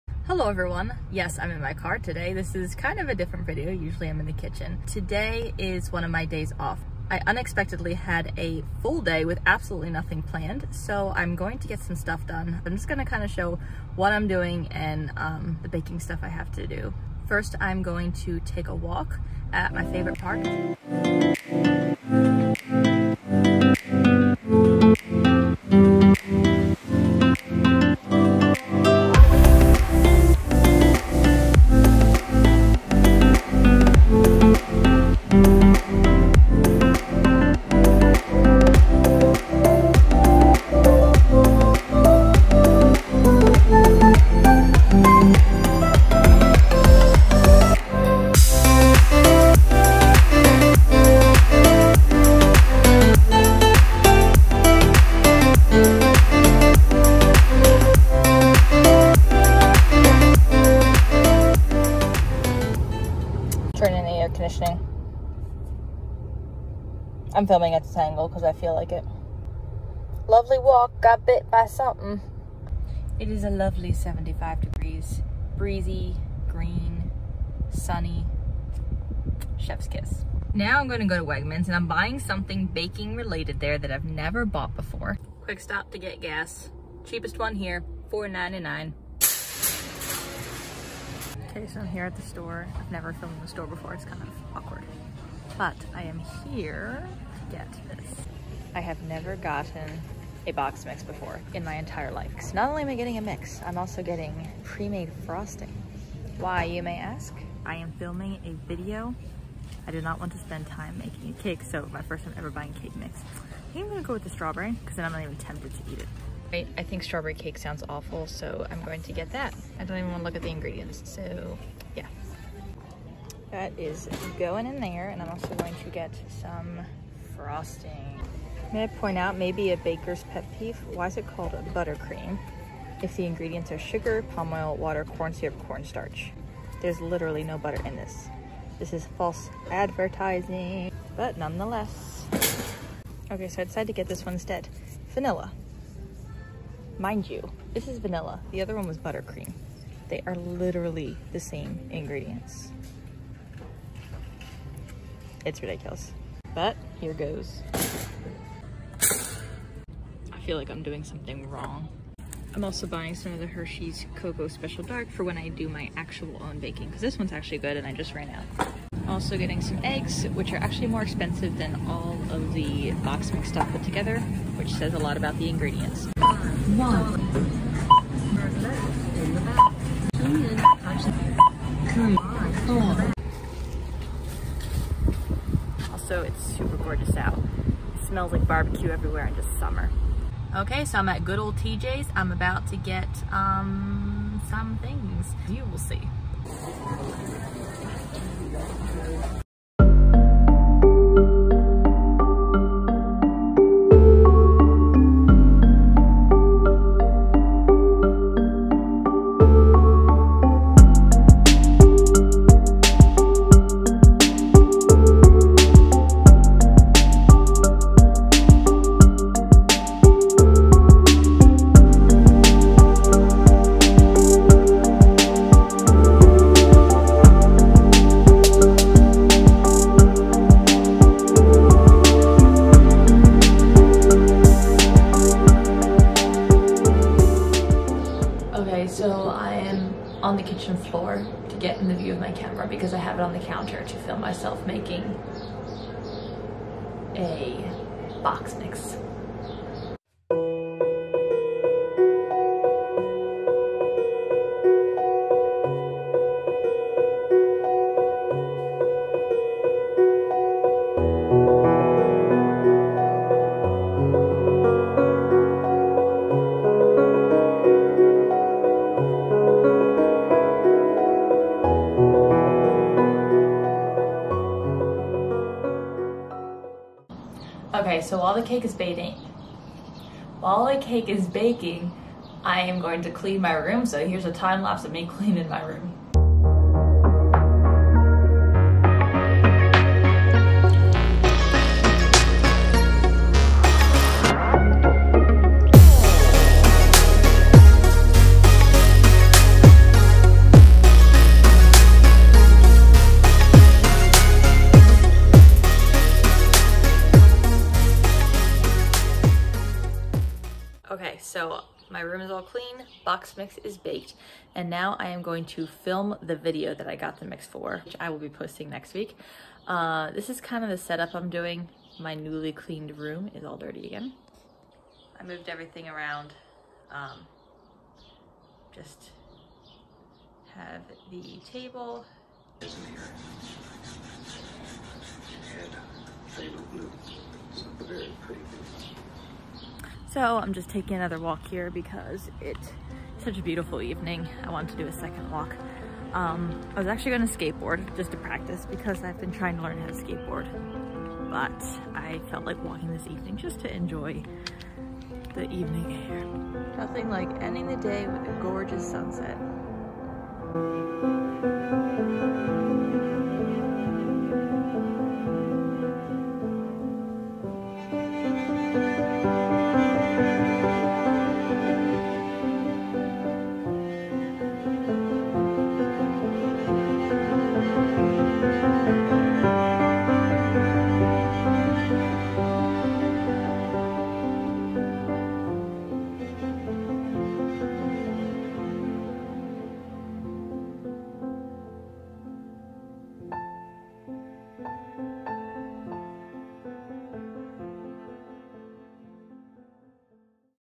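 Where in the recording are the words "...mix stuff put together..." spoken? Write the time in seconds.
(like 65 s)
173 s.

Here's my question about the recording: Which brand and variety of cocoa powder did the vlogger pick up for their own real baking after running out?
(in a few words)
Hershey's Cocoa Special Dark.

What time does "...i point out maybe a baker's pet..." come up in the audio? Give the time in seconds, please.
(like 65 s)
128 s.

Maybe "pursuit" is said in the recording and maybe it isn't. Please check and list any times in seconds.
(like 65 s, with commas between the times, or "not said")
not said.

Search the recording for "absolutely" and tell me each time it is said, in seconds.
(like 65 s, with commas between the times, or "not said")
9 s.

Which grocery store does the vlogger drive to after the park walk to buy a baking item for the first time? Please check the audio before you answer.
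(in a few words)
Wegmans.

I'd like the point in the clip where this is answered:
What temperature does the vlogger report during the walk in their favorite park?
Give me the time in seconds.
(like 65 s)
73 s.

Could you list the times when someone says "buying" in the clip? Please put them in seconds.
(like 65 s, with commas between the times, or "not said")
81 s, 112 s, 162 s.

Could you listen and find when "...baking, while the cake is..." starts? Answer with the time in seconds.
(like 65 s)
278 s.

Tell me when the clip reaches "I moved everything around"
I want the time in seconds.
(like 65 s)
325 s.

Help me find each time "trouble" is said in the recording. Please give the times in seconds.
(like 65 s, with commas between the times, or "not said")
not said.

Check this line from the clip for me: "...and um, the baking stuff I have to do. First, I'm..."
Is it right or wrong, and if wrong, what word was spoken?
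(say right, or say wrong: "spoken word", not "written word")
right.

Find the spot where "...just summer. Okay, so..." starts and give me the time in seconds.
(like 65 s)
189 s.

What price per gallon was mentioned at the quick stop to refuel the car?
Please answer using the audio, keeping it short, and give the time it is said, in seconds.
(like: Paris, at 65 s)
$4.99, at 88 s.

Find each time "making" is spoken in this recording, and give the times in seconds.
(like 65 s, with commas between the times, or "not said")
110 s, 244 s.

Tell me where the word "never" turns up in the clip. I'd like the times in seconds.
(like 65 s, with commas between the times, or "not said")
84 s, 92 s, 99 s.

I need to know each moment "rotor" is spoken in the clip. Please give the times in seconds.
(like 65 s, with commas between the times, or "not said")
not said.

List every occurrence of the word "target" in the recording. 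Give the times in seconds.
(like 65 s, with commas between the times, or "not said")
not said.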